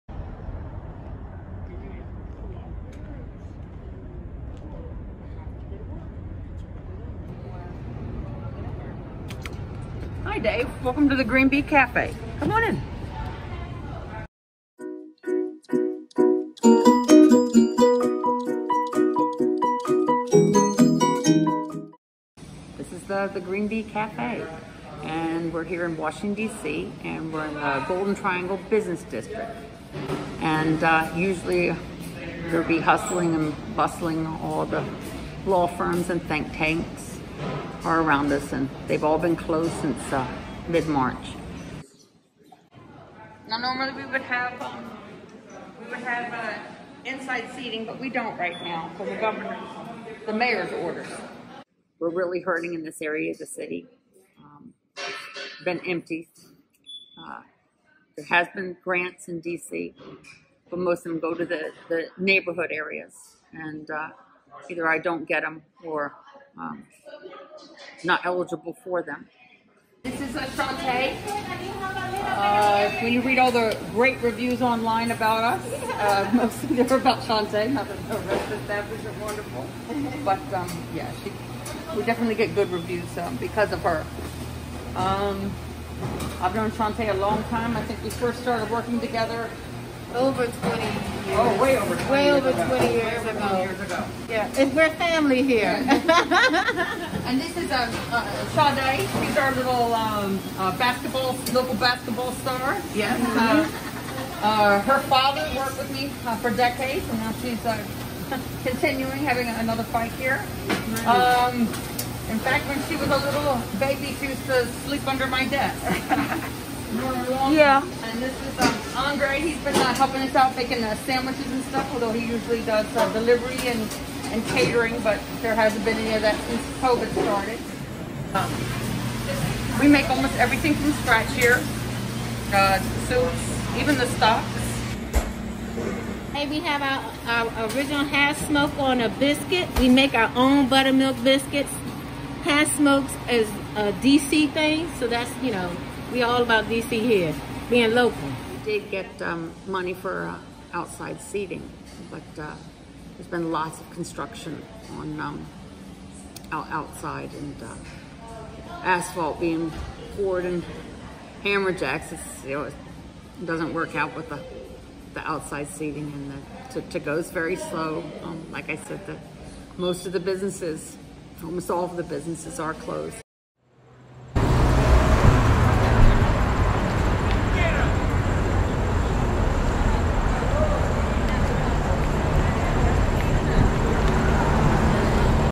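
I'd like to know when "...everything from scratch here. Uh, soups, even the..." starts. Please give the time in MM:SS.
02:10.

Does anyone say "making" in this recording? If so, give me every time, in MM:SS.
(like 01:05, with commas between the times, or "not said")
02:00.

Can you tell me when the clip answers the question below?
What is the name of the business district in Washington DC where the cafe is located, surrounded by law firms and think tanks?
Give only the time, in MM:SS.
00:27.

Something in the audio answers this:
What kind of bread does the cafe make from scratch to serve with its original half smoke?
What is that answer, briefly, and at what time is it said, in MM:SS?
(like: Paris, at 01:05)
Buttermilk biscuits, at 02:20.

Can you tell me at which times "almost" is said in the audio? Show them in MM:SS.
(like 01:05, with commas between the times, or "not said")
02:10, 02:51.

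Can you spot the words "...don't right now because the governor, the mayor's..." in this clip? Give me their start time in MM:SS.
00:48.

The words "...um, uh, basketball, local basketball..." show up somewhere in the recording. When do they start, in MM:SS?
01:39.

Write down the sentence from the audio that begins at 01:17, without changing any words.
Not that the rest of the wonderful, but um, yeah, she, we definitely get good reviews um, because of her.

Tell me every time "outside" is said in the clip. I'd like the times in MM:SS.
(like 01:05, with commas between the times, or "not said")
02:30, 02:36, 02:45.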